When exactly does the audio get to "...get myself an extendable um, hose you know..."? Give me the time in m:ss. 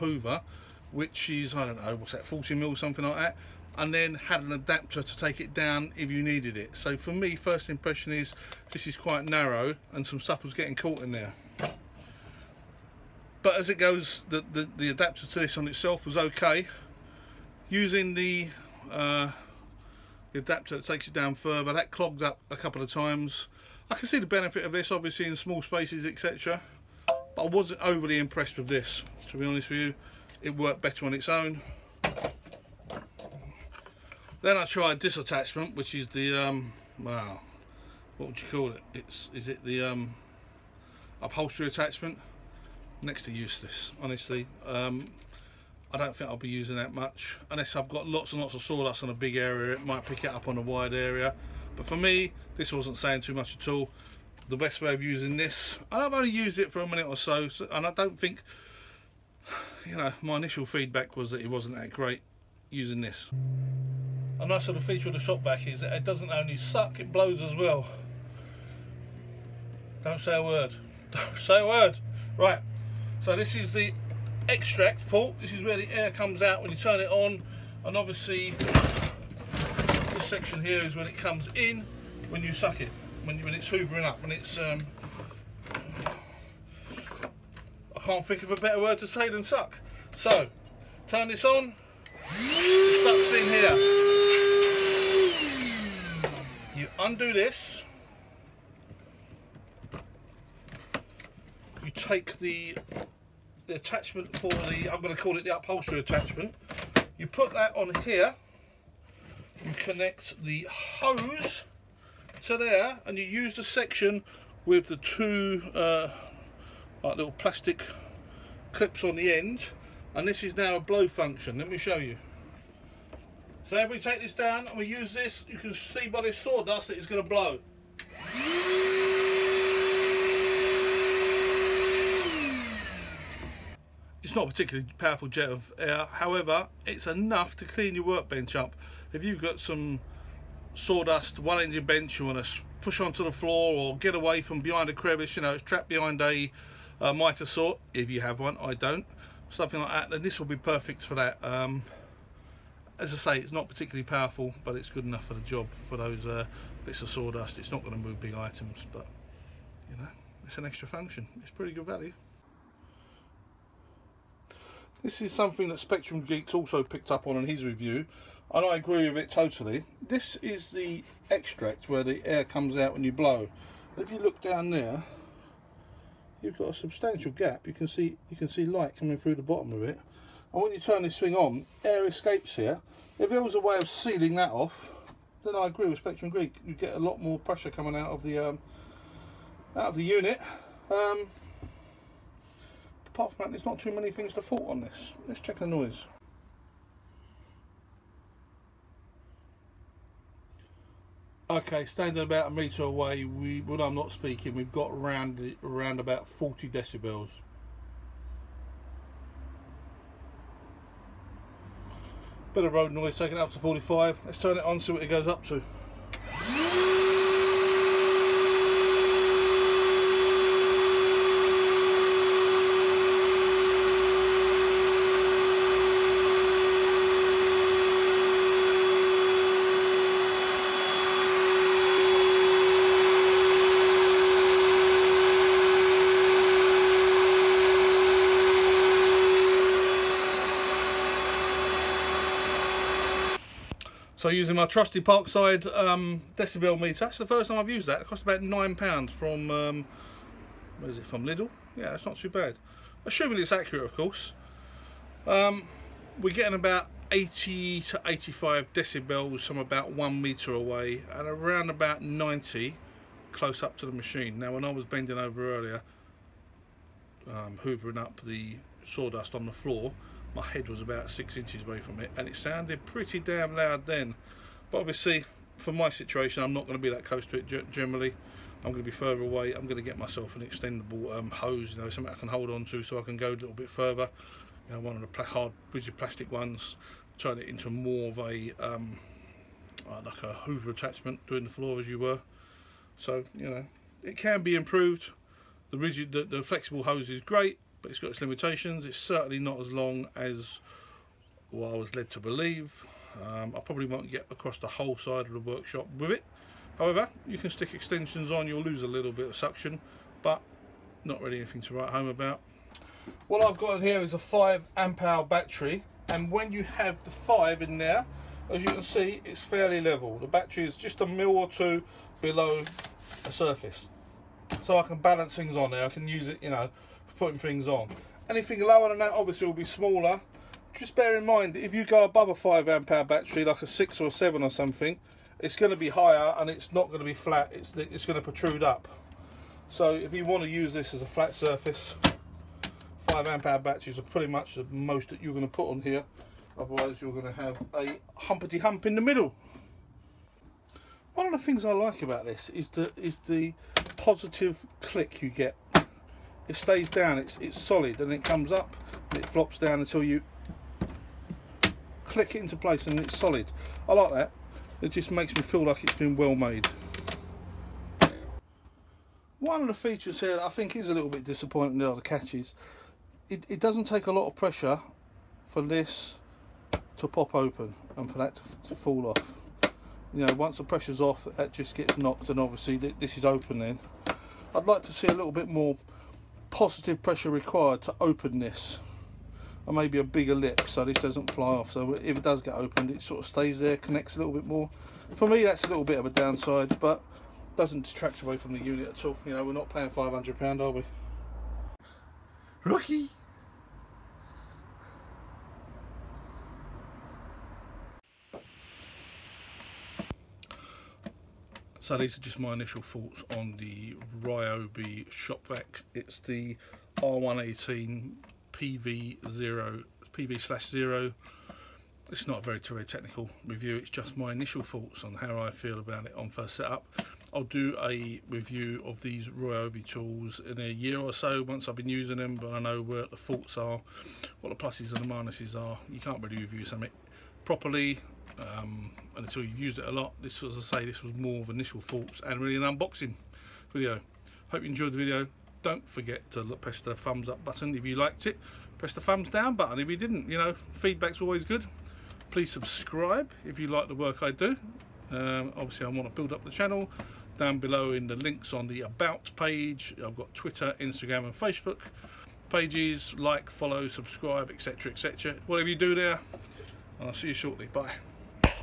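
4:39.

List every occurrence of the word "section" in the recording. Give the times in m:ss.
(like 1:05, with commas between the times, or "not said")
1:20, 1:53.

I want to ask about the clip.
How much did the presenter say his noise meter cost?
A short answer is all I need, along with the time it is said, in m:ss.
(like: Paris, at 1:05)
£9, at 4:08.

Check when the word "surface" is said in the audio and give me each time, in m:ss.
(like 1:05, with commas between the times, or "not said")
5:23, 5:41.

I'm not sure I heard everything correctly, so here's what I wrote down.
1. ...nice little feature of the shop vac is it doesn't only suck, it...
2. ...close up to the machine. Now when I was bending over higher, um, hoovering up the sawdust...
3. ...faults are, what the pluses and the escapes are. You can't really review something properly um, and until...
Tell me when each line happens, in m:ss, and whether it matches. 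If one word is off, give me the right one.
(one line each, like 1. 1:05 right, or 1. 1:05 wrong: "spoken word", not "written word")
1. 1:04 right
2. 4:23 wrong: "earlier", not "higher"
3. 7:13 wrong: "minuses", not "escapes".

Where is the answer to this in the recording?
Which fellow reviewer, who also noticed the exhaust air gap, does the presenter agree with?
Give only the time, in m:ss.
2:45.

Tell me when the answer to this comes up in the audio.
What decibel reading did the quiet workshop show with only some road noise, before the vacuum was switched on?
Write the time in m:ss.
3:26.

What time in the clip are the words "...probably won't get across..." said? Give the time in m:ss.
5:03.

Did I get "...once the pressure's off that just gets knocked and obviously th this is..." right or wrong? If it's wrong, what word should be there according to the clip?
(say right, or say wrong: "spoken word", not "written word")
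right.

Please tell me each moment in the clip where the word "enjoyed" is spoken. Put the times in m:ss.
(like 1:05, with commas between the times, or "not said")
7:24.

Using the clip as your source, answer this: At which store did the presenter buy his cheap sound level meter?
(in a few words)
Lidl.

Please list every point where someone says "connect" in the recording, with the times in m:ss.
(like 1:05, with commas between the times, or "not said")
1:49, 6:33.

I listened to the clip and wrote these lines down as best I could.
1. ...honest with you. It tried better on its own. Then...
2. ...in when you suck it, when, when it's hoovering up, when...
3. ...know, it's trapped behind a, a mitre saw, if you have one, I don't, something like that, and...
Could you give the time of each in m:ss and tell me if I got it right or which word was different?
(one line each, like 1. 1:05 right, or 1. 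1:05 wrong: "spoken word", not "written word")
1. 0:29 wrong: "worked", not "tried"
2. 1:21 right
3. 2:25 right.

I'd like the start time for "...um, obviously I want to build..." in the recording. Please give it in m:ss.
7:35.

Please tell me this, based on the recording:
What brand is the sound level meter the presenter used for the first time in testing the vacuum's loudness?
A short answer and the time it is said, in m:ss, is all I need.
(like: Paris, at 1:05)
Parkside, at 4:04.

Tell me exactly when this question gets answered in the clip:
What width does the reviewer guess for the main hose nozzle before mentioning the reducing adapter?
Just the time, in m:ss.
0:02.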